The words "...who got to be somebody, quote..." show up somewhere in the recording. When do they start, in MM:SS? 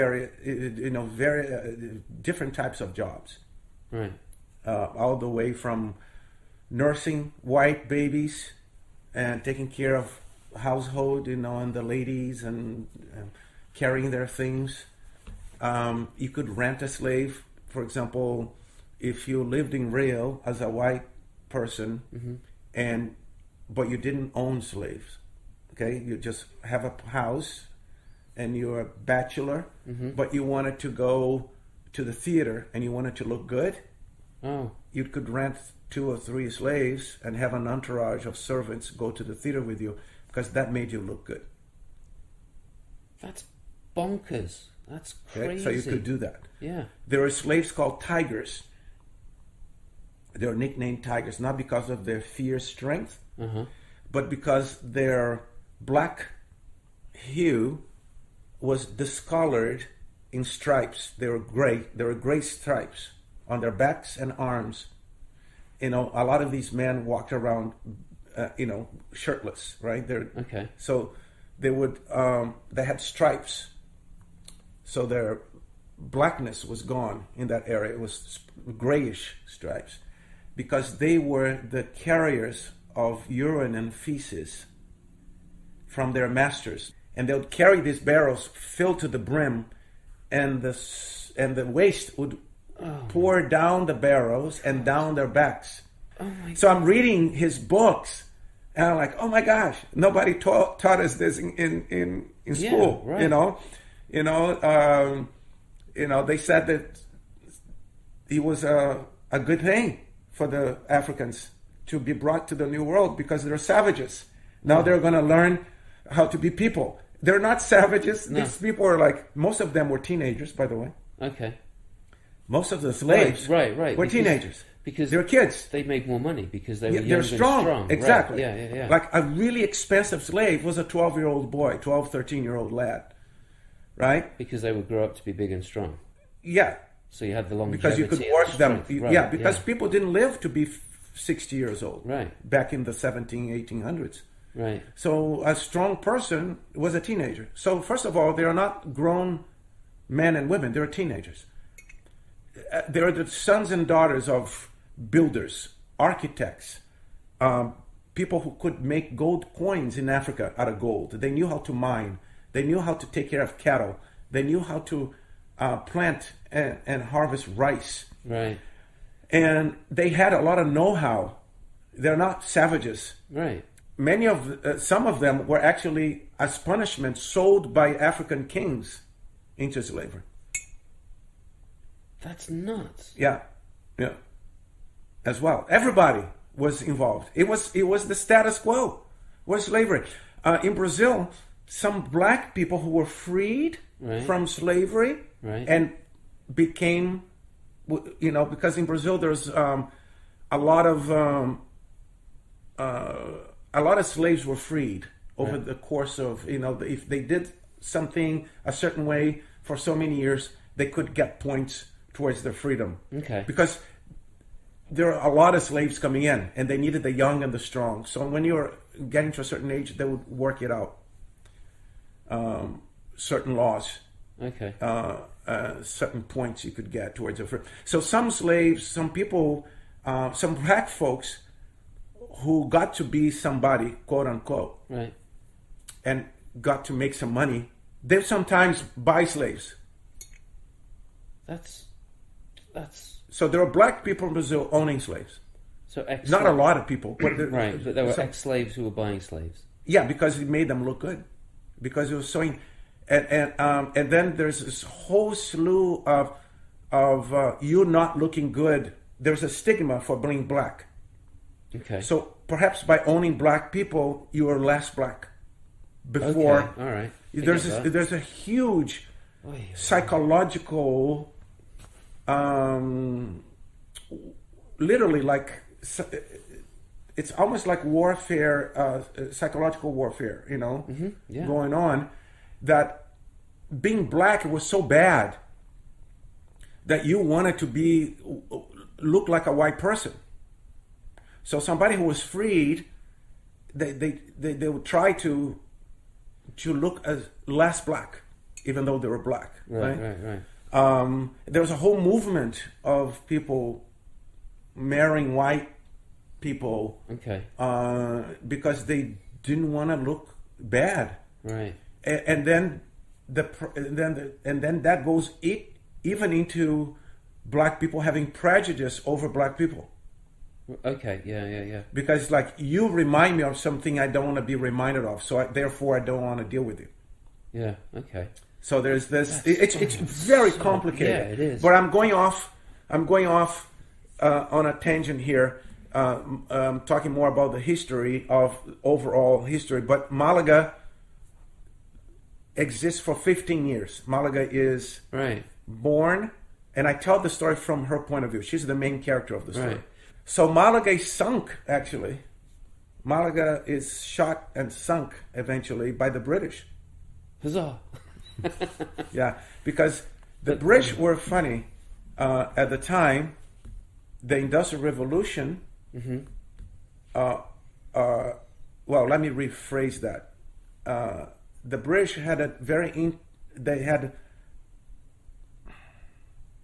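03:52.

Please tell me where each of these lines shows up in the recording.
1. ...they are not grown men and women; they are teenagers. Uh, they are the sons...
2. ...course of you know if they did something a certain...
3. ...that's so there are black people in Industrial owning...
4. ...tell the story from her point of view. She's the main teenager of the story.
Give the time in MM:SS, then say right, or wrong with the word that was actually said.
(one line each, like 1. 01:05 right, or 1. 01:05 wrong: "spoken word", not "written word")
1. 02:28 right
2. 03:25 right
3. 04:02 wrong: "Brazil", not "Industrial"
4. 05:46 wrong: "character", not "teenager".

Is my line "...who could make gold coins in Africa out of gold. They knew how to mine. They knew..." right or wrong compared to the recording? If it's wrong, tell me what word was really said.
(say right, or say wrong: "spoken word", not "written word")
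right.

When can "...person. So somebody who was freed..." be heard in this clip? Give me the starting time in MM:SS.
04:49.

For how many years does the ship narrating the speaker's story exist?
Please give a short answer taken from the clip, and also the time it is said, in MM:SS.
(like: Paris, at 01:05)
15, at 05:43.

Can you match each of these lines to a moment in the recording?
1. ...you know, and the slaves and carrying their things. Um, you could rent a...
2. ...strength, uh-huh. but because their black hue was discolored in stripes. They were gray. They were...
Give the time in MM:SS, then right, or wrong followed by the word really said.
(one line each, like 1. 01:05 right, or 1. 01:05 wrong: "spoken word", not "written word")
1. 00:11 wrong: "ladies", not "slaves"
2. 00:52 right.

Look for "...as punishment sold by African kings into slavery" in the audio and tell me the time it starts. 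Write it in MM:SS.
02:56.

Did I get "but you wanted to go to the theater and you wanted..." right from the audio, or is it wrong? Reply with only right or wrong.
right.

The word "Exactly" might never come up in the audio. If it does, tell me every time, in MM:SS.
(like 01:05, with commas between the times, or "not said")
02:07.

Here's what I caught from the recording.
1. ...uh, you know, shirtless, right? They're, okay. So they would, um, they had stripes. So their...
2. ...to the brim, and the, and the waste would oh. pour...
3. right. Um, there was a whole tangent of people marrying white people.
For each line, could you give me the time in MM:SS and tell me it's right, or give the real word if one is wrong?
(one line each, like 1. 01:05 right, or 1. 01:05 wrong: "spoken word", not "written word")
1. 01:08 right
2. 01:29 right
3. 05:00 wrong: "movement", not "tangent".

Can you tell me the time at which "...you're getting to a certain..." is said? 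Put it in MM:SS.
03:38.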